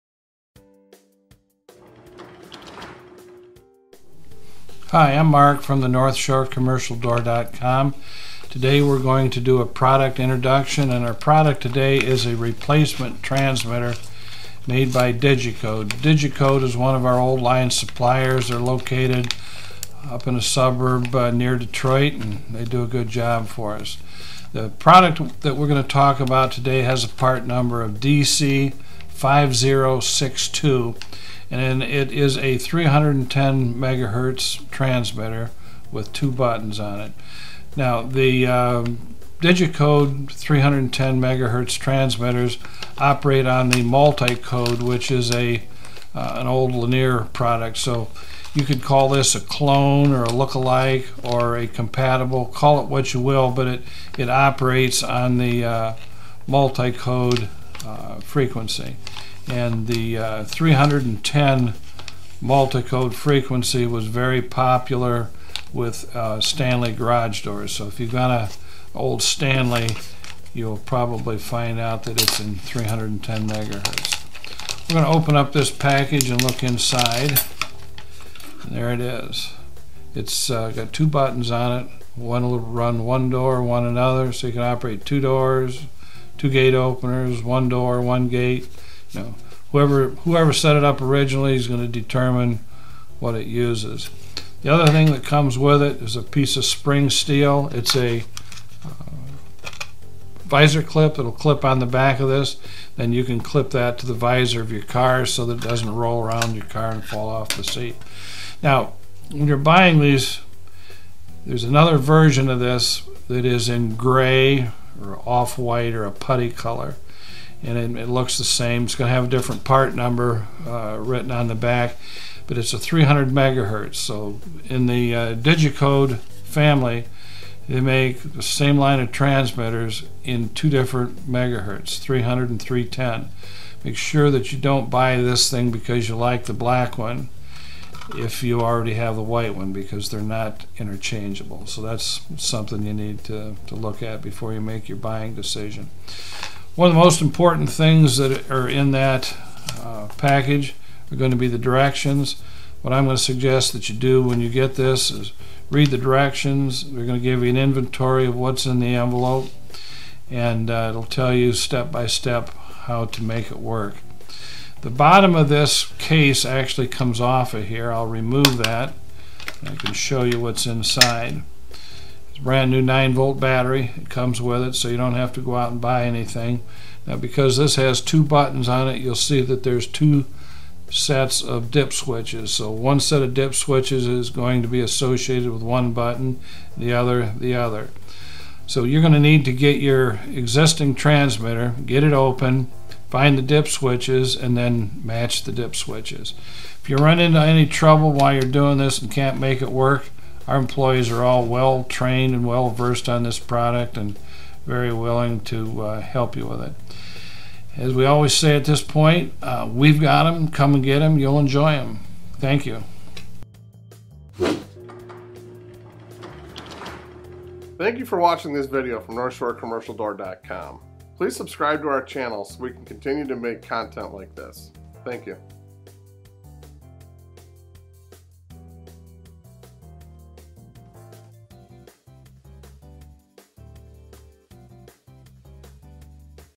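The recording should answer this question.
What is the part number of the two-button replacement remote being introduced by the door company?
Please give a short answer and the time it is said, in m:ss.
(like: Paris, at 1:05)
DC 5062, at 0:28.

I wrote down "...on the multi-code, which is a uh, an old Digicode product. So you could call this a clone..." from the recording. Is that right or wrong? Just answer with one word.
wrong.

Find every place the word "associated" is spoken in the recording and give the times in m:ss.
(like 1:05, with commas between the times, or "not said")
3:04.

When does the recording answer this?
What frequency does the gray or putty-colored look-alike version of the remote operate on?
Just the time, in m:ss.
2:02.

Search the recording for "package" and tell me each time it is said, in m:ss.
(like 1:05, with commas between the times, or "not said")
1:15, 2:30.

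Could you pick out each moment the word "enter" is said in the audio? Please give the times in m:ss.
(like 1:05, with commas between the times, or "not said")
not said.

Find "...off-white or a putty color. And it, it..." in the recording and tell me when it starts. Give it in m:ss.
1:55.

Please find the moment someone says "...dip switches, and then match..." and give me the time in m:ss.
3:13.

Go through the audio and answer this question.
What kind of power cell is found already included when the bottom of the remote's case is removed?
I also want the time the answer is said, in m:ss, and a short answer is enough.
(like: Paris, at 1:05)
9 volt battery, at 2:52.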